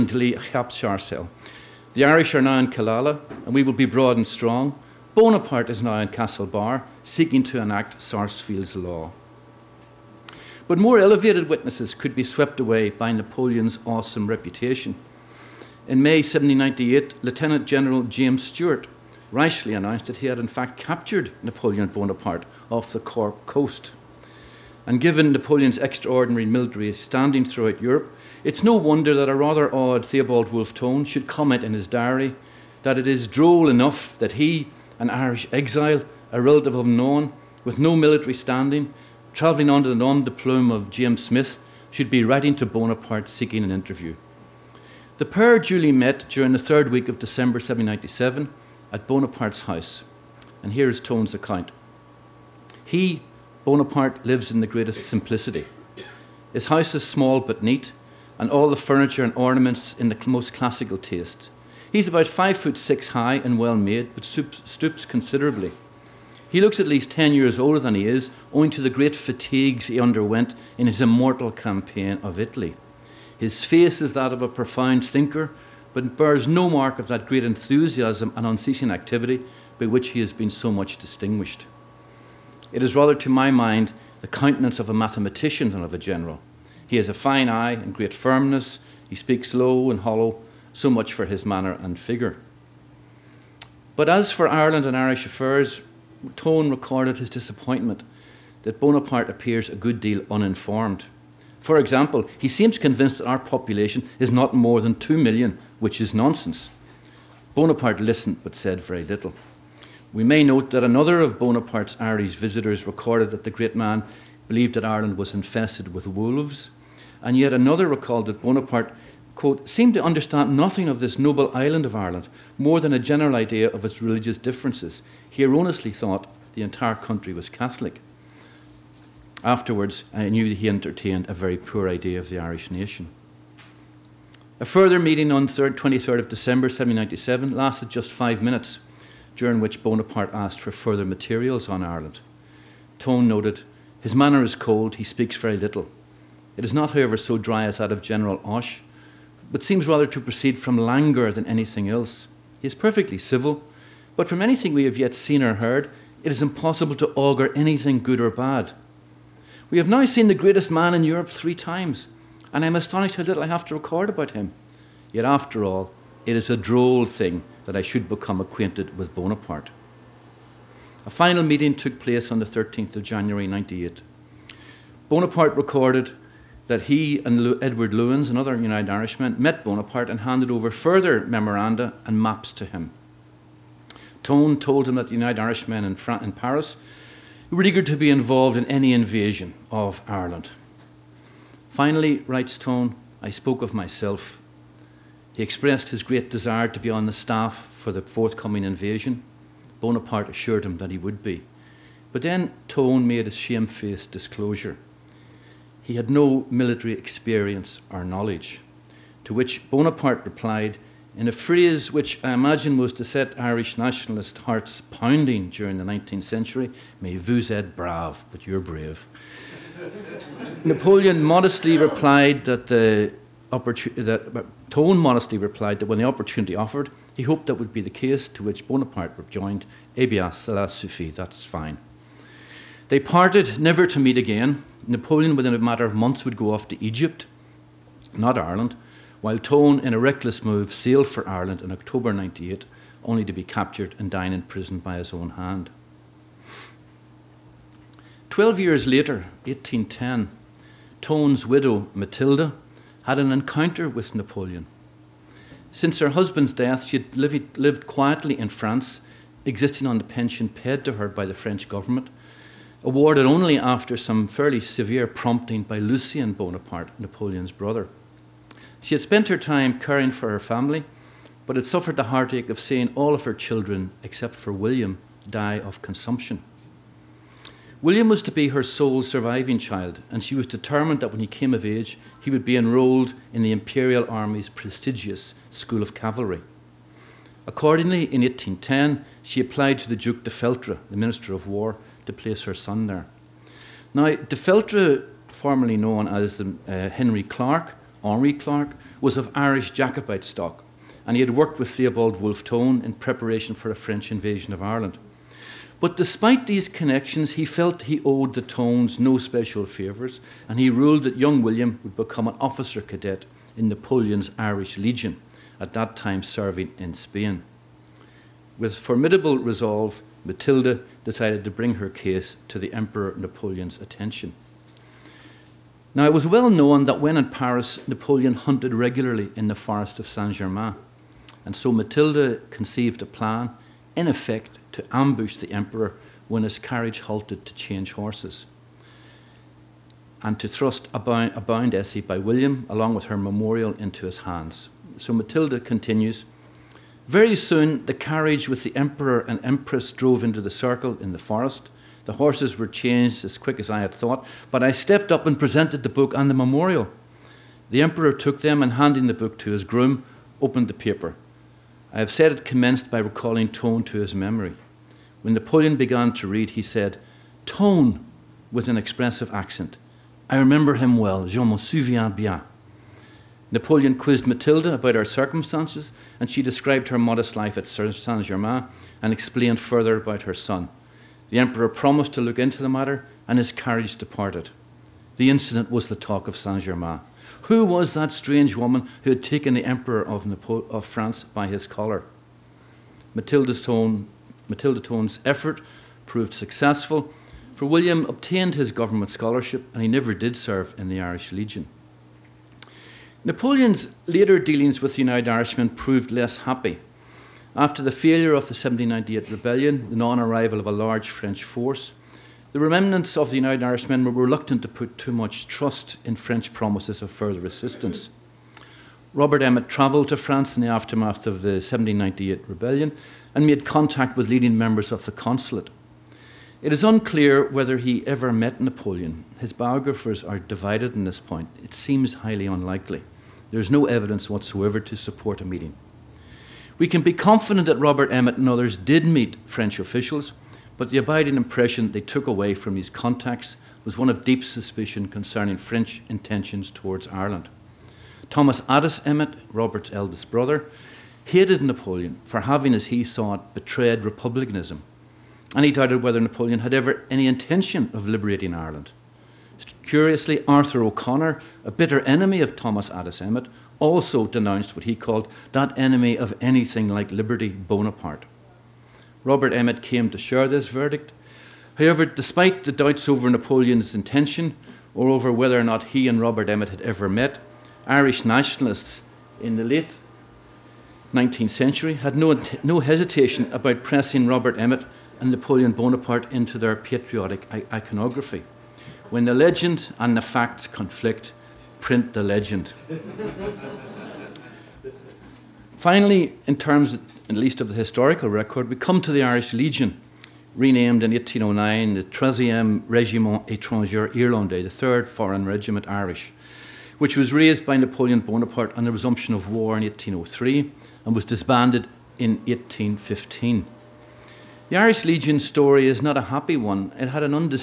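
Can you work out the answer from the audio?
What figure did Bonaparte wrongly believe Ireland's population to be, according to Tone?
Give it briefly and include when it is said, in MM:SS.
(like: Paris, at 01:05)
2 million, at 01:44.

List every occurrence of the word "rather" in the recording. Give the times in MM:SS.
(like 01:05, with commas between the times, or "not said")
00:29, 01:22, 02:29.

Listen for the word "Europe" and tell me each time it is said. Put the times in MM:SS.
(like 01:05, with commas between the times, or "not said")
00:27, 02:41.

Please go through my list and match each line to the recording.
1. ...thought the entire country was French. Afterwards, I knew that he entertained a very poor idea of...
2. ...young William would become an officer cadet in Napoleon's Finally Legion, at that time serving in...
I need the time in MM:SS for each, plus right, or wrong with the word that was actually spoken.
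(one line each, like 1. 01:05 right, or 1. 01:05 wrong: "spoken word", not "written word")
1. 02:05 wrong: "Catholic", not "French"
2. 05:11 wrong: "Irish", not "Finally".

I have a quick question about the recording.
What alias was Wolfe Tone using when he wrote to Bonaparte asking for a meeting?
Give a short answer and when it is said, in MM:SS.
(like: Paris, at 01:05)
James Smith, at 00:40.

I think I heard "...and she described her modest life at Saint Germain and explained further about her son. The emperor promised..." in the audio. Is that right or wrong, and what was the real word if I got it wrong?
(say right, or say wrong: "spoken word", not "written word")
right.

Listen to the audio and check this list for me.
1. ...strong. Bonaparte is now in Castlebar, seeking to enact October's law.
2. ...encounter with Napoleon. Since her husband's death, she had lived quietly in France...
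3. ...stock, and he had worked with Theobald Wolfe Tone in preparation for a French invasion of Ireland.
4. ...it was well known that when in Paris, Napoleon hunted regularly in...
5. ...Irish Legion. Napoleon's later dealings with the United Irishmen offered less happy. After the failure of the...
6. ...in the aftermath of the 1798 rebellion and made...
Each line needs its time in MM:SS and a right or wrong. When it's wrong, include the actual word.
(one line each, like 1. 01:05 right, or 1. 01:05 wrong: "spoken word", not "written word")
1. 00:04 wrong: "Sarsfield", not "October"
2. 04:13 right
3. 05:00 right
4. 05:26 right
5. 06:41 wrong: "proved", not "offered"
6. 07:00 right.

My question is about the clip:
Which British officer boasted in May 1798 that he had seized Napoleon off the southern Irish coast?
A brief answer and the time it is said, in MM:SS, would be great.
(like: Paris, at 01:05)
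James Stewart, at 00:18.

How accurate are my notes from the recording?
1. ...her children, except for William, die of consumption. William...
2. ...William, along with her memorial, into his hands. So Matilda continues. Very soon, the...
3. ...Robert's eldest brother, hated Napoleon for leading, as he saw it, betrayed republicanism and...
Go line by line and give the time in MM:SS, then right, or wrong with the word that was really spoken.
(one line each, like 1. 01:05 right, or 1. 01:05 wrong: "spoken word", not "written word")
1. 04:33 right
2. 05:42 right
3. 07:29 wrong: "having", not "leading".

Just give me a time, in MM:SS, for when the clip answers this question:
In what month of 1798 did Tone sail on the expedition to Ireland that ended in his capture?
04:01.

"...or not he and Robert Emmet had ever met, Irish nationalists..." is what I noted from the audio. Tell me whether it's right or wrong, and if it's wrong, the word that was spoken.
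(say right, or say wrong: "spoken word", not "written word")
right.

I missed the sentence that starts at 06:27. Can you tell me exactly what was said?
Who was that strange woman who had taken the emperor of, Napo of France by his collar?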